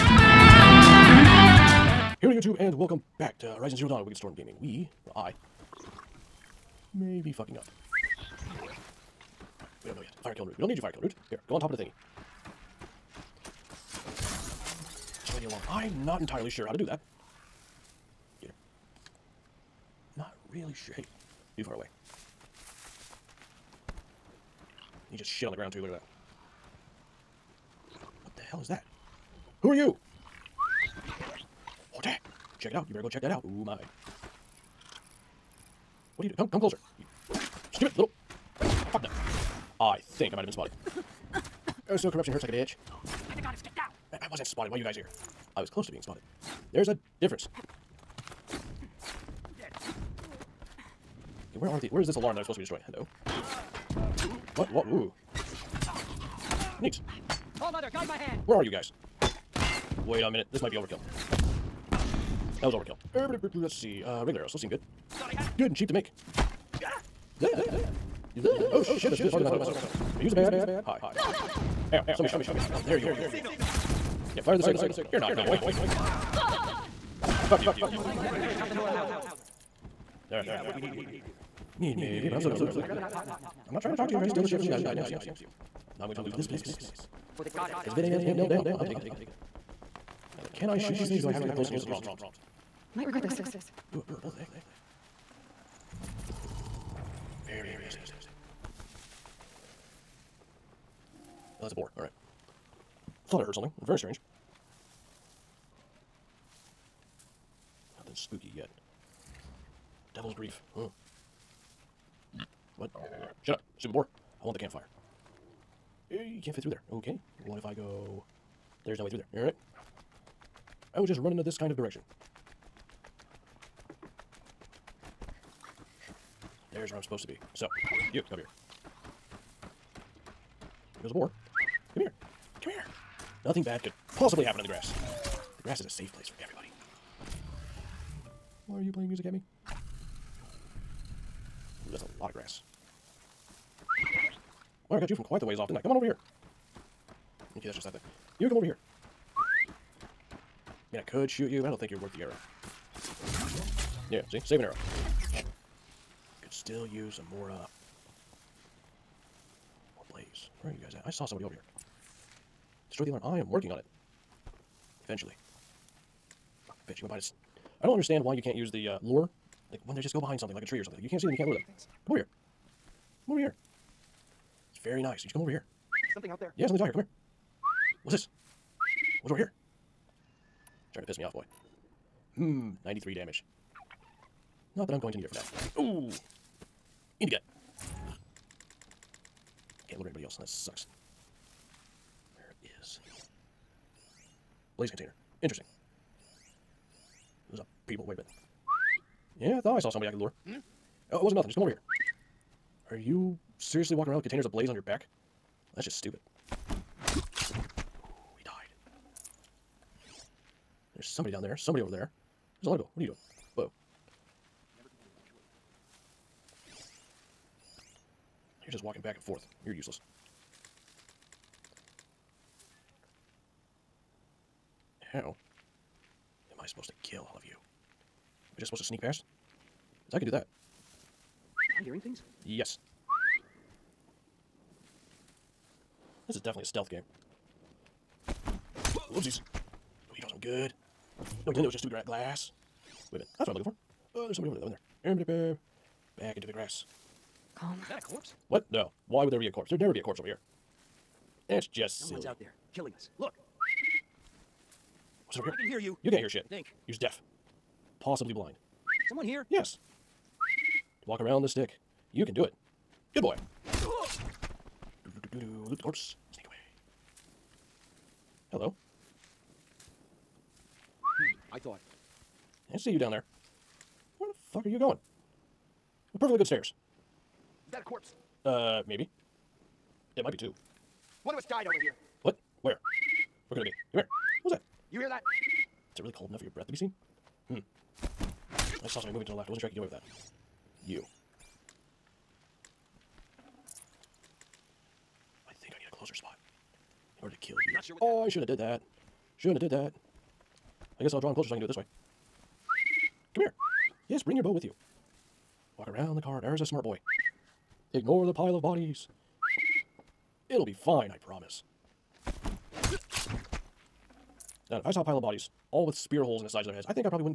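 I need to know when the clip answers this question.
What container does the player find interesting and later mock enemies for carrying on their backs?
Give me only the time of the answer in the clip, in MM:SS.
03:14.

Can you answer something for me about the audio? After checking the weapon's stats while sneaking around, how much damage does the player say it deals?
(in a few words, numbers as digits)
93.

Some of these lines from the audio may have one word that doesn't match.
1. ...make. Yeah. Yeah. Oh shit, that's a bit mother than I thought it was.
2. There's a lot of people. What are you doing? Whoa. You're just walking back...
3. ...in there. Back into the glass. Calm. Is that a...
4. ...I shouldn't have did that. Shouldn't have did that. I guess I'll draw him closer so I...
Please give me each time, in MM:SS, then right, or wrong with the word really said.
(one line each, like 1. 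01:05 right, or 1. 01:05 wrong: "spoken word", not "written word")
1. 01:05 wrong: "farther", not "mother"
2. 03:32 right
3. 04:04 wrong: "grass", not "glass"
4. 04:58 right.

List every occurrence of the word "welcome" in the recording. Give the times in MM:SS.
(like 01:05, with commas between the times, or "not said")
00:02.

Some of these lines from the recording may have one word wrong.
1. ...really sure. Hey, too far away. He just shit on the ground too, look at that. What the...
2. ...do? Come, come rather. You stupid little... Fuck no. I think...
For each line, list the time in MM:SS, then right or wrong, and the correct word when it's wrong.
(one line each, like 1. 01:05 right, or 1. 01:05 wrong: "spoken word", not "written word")
1. 00:20 right
2. 00:36 wrong: "closer", not "rather".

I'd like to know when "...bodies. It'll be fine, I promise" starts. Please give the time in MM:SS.
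05:08.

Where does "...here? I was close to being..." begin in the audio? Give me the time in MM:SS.
00:44.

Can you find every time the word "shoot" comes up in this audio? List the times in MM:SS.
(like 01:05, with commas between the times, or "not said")
01:30, 02:31.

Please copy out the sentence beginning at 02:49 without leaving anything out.
Like, when they just go behind something, like a tree or something.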